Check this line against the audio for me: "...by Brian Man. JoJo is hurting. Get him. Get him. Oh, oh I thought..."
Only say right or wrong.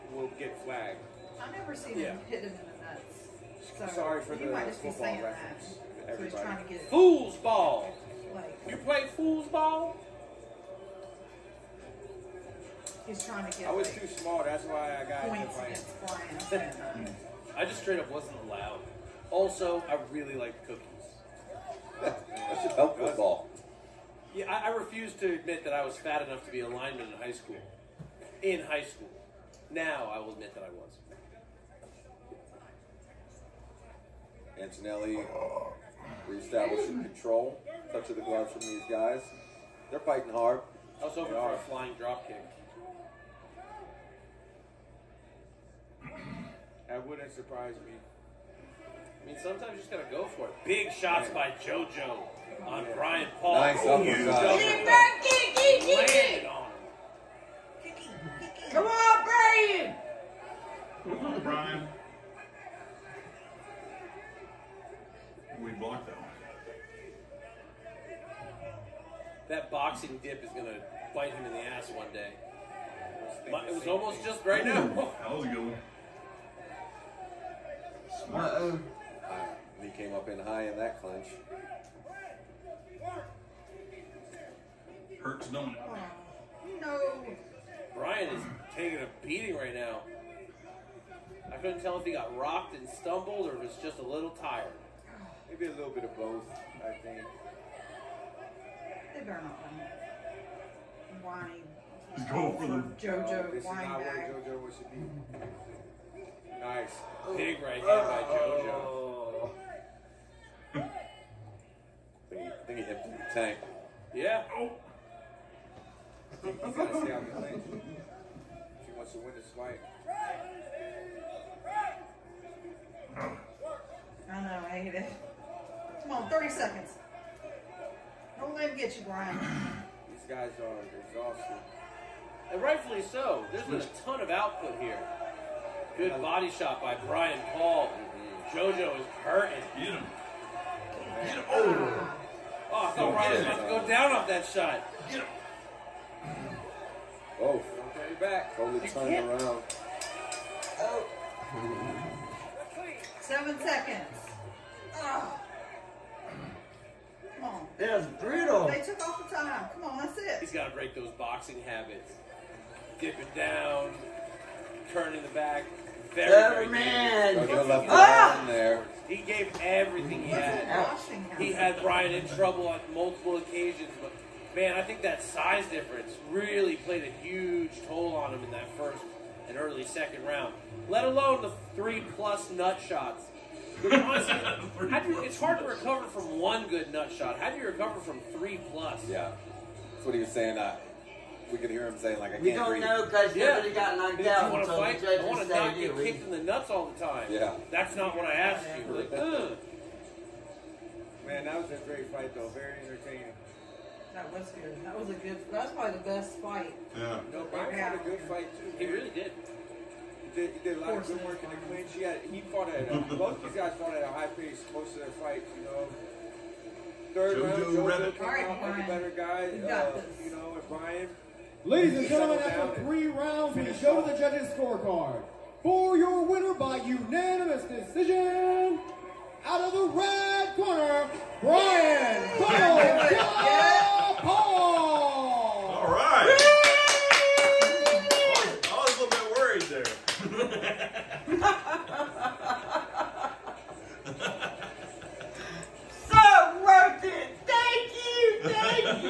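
wrong.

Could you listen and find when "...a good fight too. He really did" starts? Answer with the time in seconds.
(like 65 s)
207 s.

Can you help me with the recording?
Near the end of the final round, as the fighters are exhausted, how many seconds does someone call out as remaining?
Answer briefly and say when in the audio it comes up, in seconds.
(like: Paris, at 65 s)
7, at 153 s.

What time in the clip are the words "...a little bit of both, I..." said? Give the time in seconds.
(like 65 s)
95 s.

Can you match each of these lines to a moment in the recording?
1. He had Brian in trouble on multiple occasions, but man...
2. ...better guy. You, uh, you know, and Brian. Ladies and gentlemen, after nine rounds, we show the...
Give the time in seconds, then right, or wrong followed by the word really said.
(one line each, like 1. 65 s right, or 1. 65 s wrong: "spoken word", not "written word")
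1. 171 s right
2. 218 s wrong: "three", not "nine".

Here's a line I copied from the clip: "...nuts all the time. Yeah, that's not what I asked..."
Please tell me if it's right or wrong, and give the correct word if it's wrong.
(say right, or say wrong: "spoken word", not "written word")
right.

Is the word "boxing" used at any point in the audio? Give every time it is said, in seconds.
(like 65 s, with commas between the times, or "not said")
69 s, 161 s.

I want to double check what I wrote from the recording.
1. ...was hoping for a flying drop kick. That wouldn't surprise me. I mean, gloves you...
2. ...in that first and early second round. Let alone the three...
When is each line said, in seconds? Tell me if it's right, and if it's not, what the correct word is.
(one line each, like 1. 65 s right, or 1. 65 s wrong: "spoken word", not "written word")
1. 41 s wrong: "sometimes", not "gloves"
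2. 178 s right.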